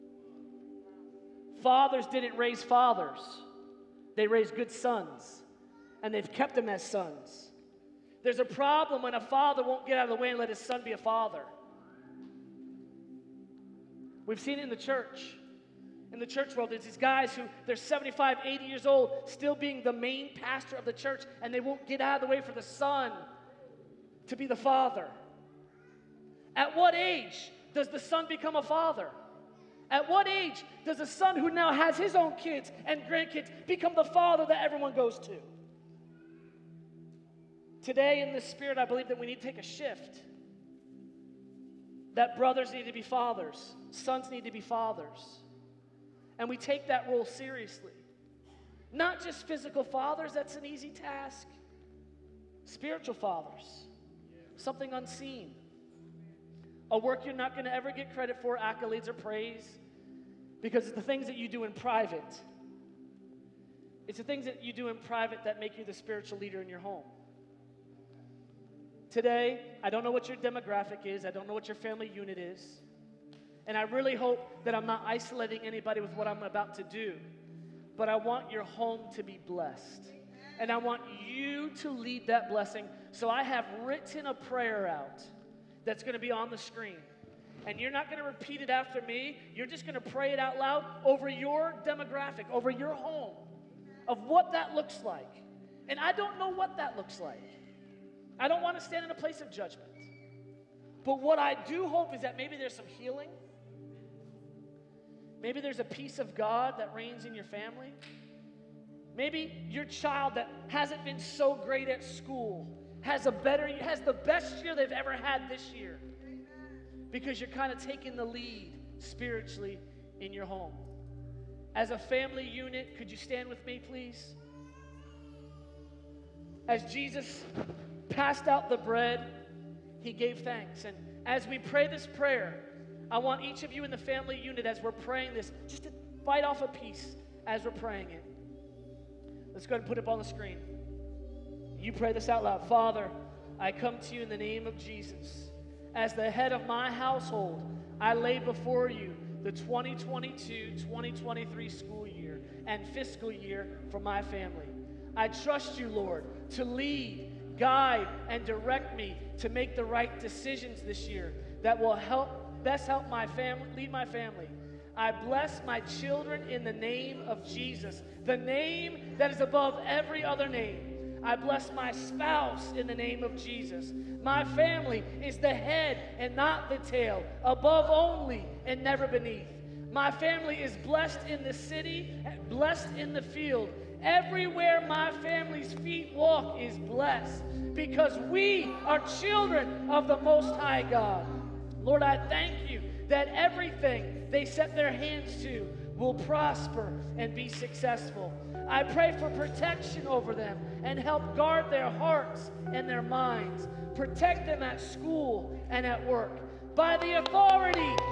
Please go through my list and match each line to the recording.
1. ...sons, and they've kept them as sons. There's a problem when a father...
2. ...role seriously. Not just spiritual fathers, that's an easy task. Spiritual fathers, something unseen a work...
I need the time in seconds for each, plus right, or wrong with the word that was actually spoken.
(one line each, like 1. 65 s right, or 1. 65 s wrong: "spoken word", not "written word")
1. 4 s right
2. 47 s wrong: "physical", not "spiritual".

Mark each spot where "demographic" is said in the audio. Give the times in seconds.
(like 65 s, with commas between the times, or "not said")
70 s, 91 s.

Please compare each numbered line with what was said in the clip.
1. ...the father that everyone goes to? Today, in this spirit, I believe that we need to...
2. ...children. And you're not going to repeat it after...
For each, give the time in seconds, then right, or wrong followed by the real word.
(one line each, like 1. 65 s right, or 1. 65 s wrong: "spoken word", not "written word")
1. 33 s right
2. 86 s wrong: "screen", not "children".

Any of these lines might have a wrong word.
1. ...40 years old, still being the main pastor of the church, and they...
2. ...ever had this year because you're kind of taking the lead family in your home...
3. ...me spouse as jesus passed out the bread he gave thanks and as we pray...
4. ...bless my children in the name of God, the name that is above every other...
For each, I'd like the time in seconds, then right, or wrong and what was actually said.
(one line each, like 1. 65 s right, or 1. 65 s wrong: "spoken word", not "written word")
1. 18 s wrong: "80", not "40"
2. 114 s wrong: "spiritually", not "family"
3. 123 s wrong: "please", not "spouse"
4. 165 s wrong: "Jesus", not "God".